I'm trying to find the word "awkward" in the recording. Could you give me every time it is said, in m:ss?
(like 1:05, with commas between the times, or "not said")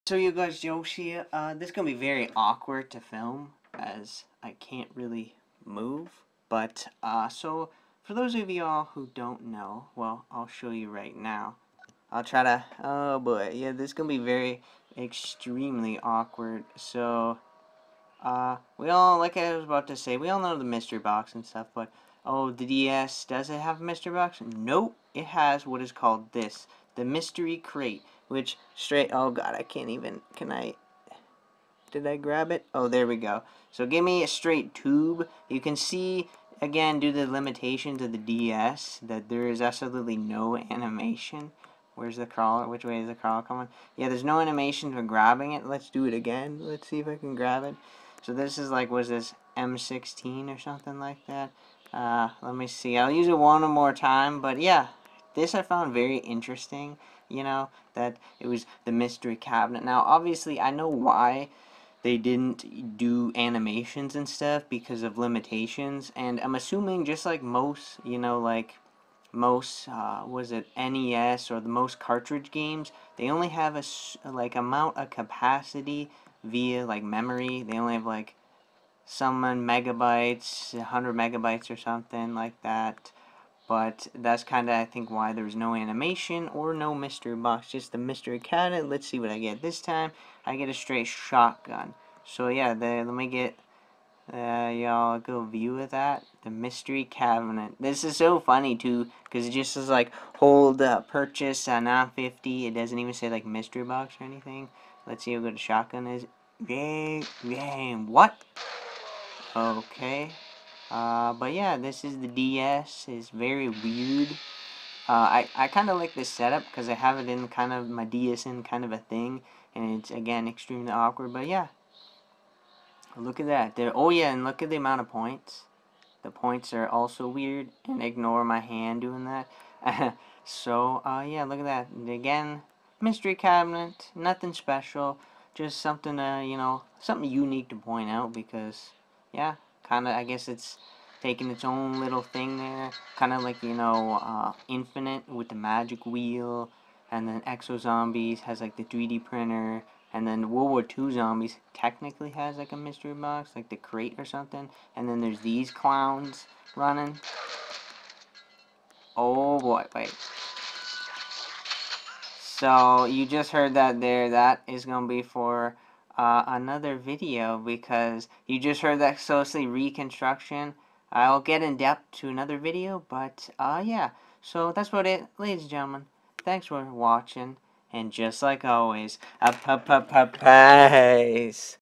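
0:02, 0:16, 2:00.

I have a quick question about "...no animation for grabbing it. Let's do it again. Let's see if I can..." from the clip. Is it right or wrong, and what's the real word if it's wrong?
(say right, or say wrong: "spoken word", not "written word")
right.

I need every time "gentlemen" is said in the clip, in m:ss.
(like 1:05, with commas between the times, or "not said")
2:55.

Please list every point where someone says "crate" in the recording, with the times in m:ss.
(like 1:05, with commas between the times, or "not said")
0:27, 2:33.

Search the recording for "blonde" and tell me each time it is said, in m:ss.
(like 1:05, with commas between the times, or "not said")
not said.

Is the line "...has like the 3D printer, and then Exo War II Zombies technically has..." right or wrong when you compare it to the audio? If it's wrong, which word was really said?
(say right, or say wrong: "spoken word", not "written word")
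wrong: "World", not "Exo".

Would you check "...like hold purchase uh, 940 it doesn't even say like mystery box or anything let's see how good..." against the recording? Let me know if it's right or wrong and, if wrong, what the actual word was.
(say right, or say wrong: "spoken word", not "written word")
wrong: "950", not "940".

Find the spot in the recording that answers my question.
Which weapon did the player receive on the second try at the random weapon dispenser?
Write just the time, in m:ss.
1:30.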